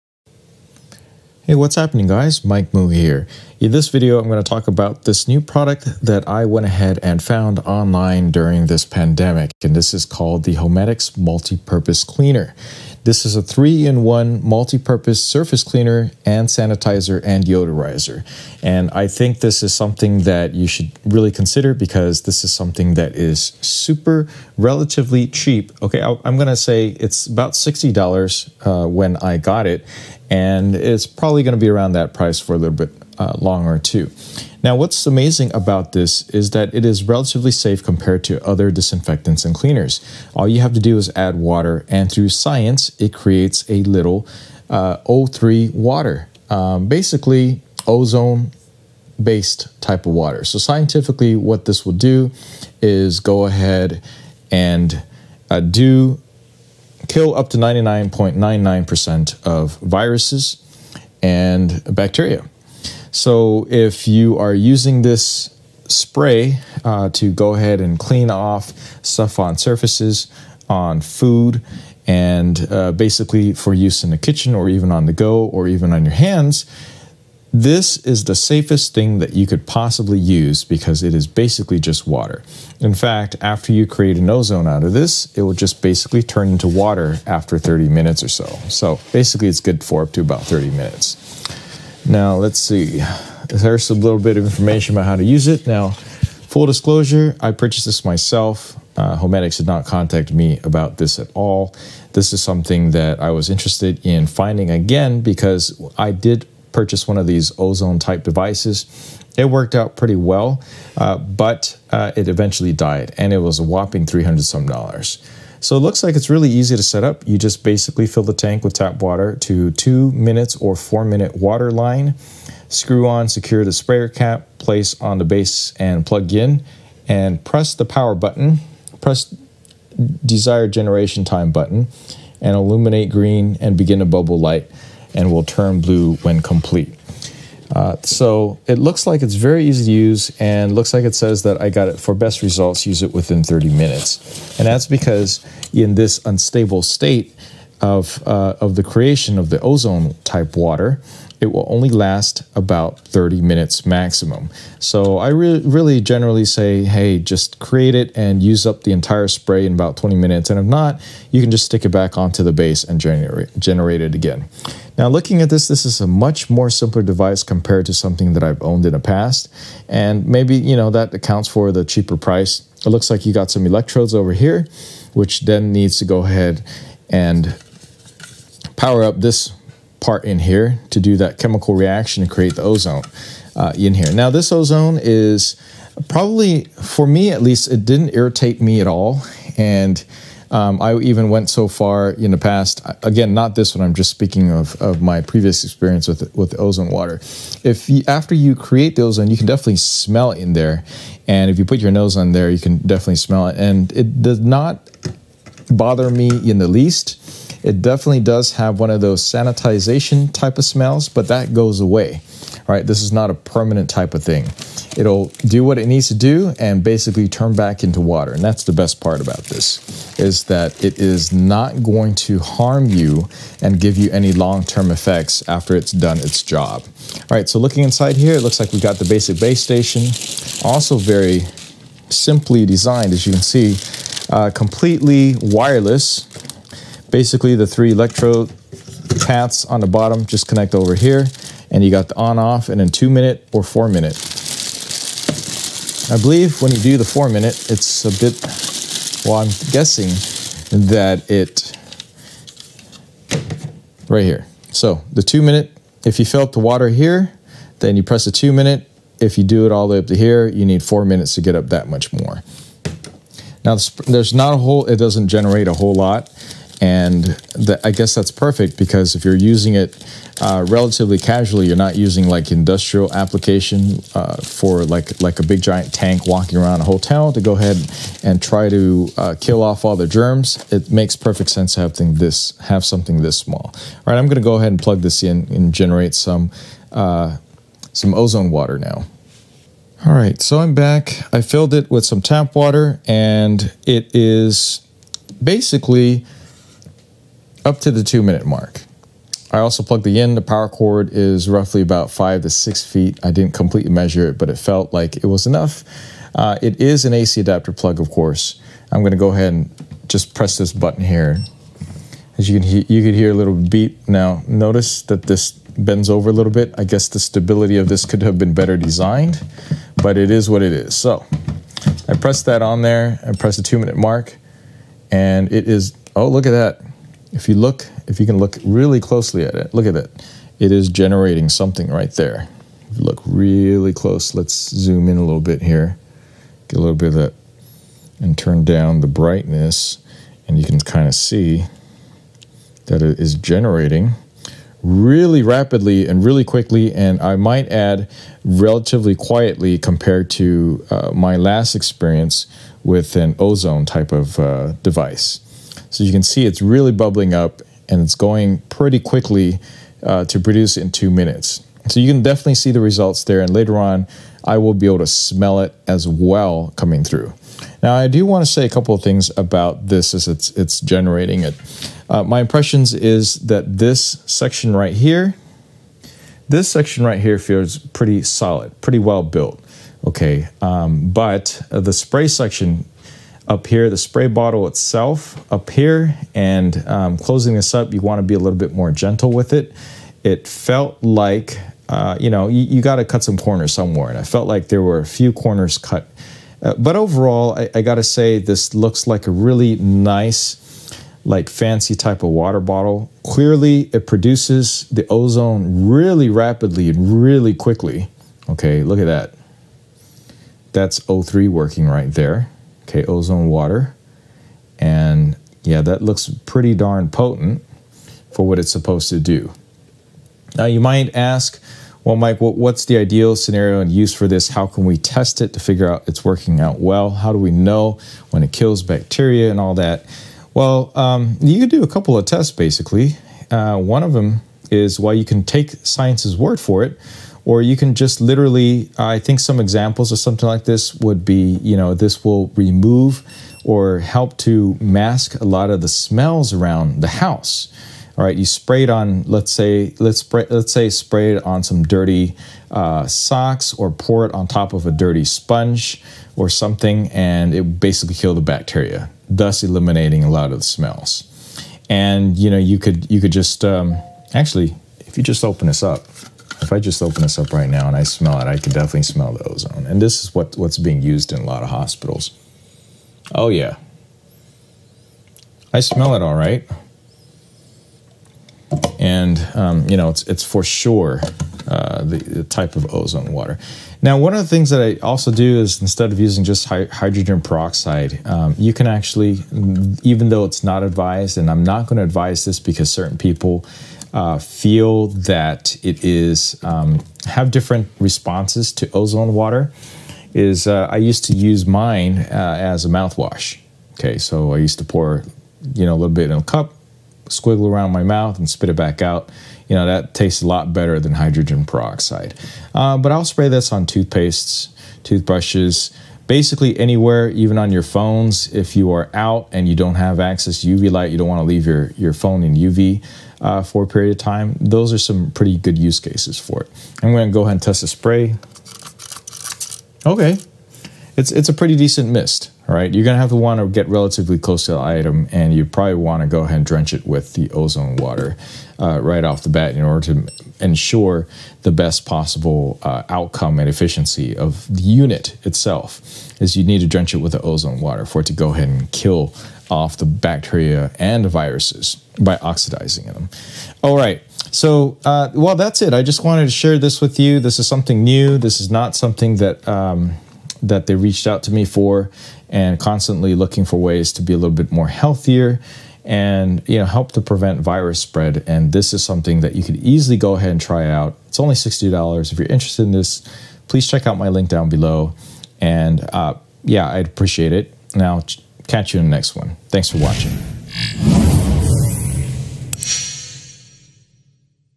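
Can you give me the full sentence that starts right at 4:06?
I believe when you do the four-minute, it's a bit, well, I'm guessing that it, right here.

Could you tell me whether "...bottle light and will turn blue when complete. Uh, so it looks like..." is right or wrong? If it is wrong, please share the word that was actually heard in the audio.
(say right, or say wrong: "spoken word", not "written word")
wrong: "bubble", not "bottle".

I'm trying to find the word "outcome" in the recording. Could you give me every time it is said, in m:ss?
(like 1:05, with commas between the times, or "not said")
9:03.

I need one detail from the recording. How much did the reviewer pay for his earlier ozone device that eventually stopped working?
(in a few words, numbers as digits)
300 some dollars.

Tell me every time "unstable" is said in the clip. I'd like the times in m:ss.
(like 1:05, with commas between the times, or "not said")
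2:26.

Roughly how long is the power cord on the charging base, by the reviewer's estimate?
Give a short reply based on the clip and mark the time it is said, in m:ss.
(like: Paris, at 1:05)
5 to 6 feet, at 5:02.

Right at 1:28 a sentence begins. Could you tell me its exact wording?
So basically, it's good for up to about 30 minutes.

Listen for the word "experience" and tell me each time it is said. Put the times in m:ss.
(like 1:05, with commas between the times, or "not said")
3:15, 5:51.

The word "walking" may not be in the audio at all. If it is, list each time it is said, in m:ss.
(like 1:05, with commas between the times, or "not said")
4:36.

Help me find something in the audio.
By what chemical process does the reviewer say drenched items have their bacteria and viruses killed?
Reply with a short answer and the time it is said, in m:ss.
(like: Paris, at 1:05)
oxidizing, at 9:12.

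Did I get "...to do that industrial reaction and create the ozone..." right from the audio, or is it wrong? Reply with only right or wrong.
wrong.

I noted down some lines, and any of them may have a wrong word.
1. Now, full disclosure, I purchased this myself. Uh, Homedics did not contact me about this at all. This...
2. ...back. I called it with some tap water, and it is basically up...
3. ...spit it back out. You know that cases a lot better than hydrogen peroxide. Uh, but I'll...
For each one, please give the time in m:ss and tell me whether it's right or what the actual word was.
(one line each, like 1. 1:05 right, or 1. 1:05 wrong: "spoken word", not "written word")
1. 1:35 right
2. 4:50 wrong: "filled", not "called"
3. 8:28 wrong: "tastes", not "cases".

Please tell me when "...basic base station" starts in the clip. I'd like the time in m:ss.
3:49.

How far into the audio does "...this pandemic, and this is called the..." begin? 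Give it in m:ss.
0:08.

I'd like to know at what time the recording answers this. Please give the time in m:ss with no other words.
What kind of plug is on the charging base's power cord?
5:07.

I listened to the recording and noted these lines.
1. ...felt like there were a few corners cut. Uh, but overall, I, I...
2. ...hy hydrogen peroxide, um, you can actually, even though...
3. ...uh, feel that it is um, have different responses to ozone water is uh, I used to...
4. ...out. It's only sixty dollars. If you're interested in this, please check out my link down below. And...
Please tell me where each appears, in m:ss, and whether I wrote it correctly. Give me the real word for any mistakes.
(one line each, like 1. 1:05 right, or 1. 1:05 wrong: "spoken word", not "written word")
1. 6:34 right
2. 8:06 right
3. 8:14 right
4. 9:30 right.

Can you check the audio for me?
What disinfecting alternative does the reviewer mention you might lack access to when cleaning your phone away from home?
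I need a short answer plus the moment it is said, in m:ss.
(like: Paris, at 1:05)
UV light, at 8:40.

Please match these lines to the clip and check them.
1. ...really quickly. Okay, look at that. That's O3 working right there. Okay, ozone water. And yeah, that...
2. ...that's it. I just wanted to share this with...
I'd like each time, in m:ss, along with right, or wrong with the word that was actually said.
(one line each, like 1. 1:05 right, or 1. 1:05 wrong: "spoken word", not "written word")
1. 6:47 right
2. 9:15 right.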